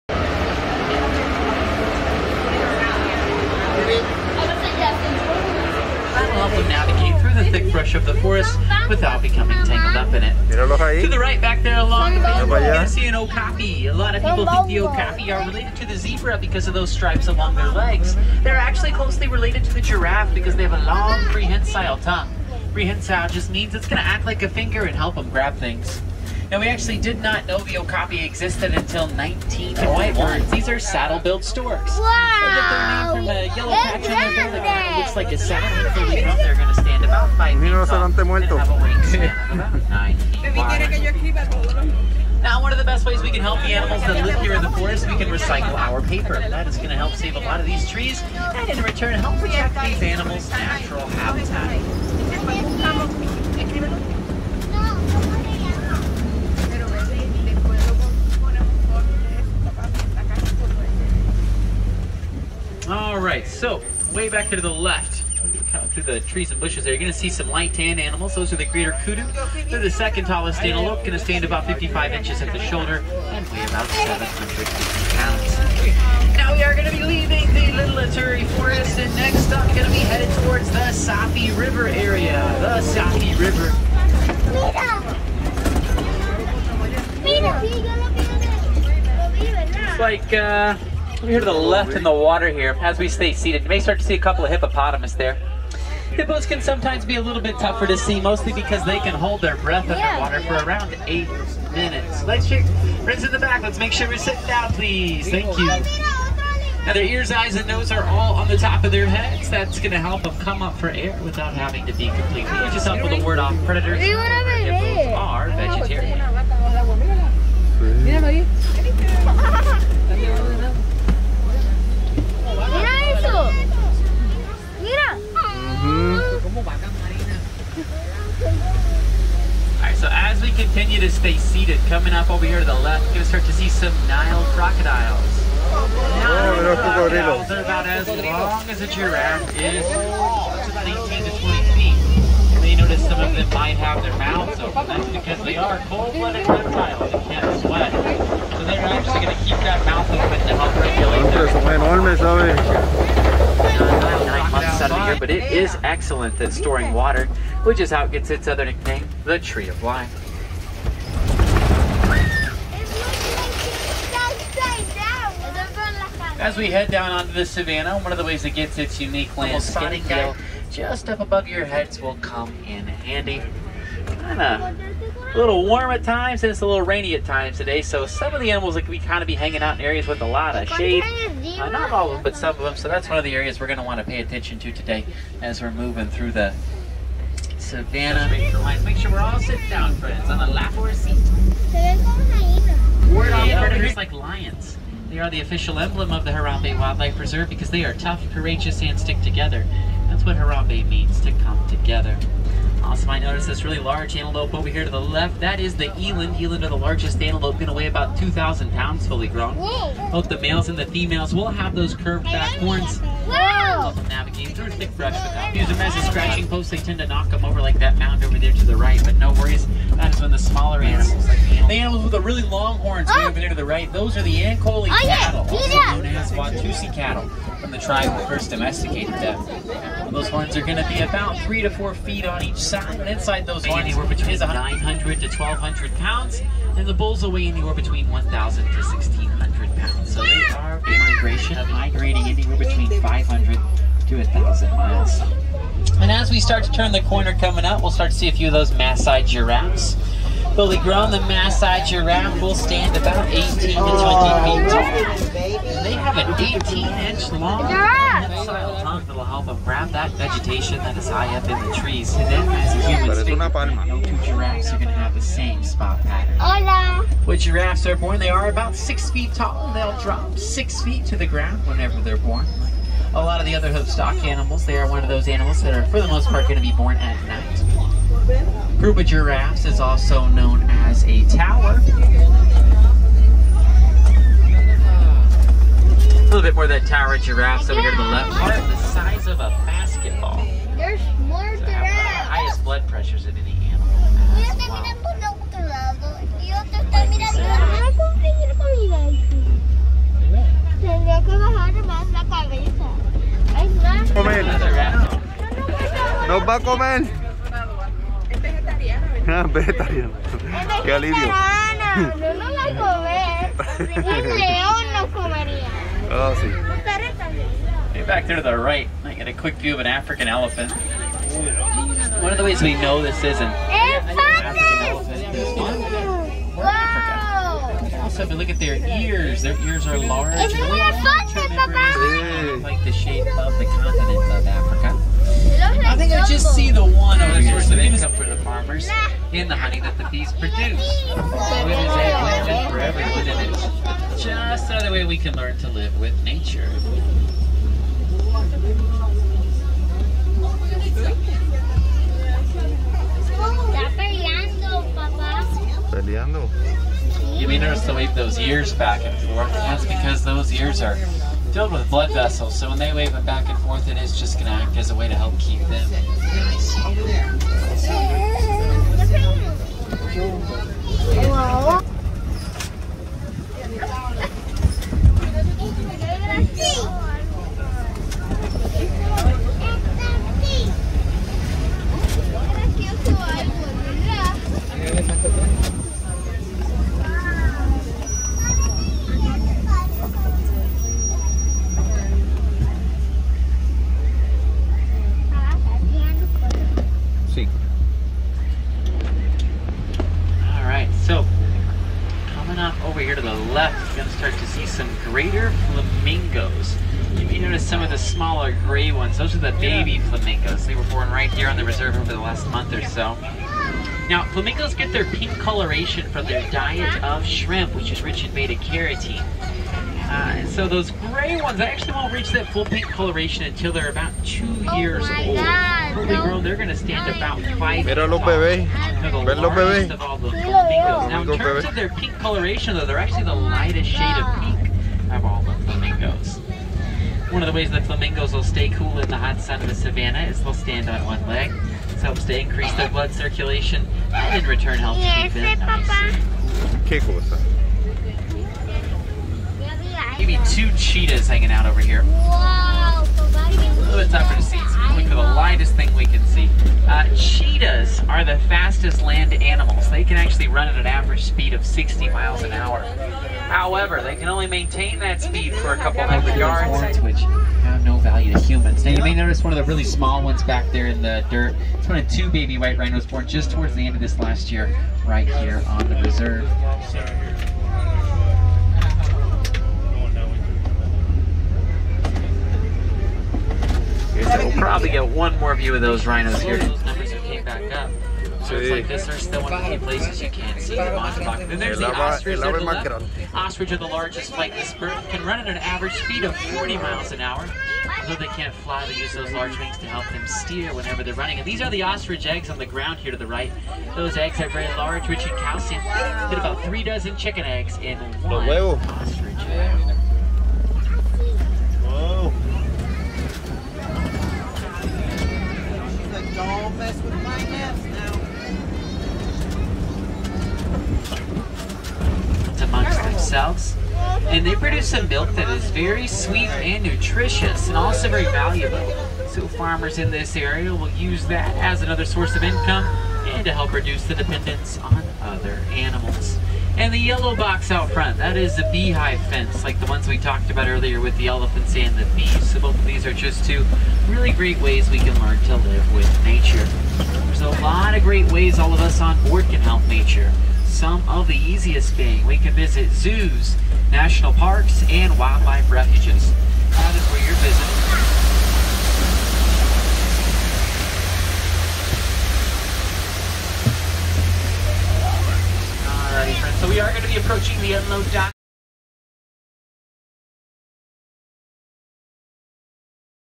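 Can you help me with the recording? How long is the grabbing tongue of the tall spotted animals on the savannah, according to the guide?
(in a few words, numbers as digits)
18 inches.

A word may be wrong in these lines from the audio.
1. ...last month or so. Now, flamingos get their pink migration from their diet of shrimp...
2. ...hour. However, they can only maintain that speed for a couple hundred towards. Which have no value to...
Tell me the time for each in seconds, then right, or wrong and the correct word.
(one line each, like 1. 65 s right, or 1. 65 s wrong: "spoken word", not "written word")
1. 412 s wrong: "coloration", not "migration"
2. 462 s wrong: "yards", not "towards".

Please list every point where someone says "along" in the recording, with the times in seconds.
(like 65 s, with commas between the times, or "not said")
11 s, 17 s.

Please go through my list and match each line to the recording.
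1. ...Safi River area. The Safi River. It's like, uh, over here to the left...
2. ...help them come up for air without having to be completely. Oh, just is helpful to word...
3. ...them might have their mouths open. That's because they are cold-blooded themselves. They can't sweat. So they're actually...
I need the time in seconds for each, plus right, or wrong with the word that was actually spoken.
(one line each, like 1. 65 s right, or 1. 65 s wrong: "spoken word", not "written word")
1. 80 s right
2. 109 s right
3. 143 s wrong: "reptiles", not "themselves".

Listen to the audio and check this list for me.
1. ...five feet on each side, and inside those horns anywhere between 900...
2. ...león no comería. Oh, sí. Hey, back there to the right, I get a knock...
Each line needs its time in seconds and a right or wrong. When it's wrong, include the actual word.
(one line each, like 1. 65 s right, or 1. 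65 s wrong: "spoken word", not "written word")
1. 231 s wrong: "four", not "five"
2. 314 s wrong: "quick", not "knock".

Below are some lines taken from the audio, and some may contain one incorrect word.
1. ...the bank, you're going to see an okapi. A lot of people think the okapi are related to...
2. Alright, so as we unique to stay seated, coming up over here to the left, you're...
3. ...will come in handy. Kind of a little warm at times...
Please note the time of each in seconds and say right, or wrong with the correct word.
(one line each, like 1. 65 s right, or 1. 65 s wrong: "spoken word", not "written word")
1. 12 s right
2. 129 s wrong: "continue", not "unique"
3. 172 s right.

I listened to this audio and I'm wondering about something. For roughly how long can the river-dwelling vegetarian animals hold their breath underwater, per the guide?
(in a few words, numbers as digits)
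8 minutes.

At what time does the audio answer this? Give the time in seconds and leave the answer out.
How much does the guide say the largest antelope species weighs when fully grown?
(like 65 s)
208 s.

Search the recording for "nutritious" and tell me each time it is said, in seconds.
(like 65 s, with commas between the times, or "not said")
526 s.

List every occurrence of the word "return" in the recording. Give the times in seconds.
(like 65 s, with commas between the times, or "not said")
48 s, 444 s.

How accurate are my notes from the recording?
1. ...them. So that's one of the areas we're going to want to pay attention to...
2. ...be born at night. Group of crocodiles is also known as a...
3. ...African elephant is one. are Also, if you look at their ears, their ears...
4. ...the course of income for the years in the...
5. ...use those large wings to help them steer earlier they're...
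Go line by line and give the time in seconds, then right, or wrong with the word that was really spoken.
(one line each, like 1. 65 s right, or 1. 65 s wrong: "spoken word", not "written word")
1. 182 s right
2. 276 s wrong: "giraffes", not "crocodiles"
3. 323 s right
4. 337 s wrong: "farmers", not "years"
5. 498 s wrong: "whenever", not "earlier".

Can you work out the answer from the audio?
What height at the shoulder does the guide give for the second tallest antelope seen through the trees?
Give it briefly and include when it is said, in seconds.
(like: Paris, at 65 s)
55 inches, at 71 s.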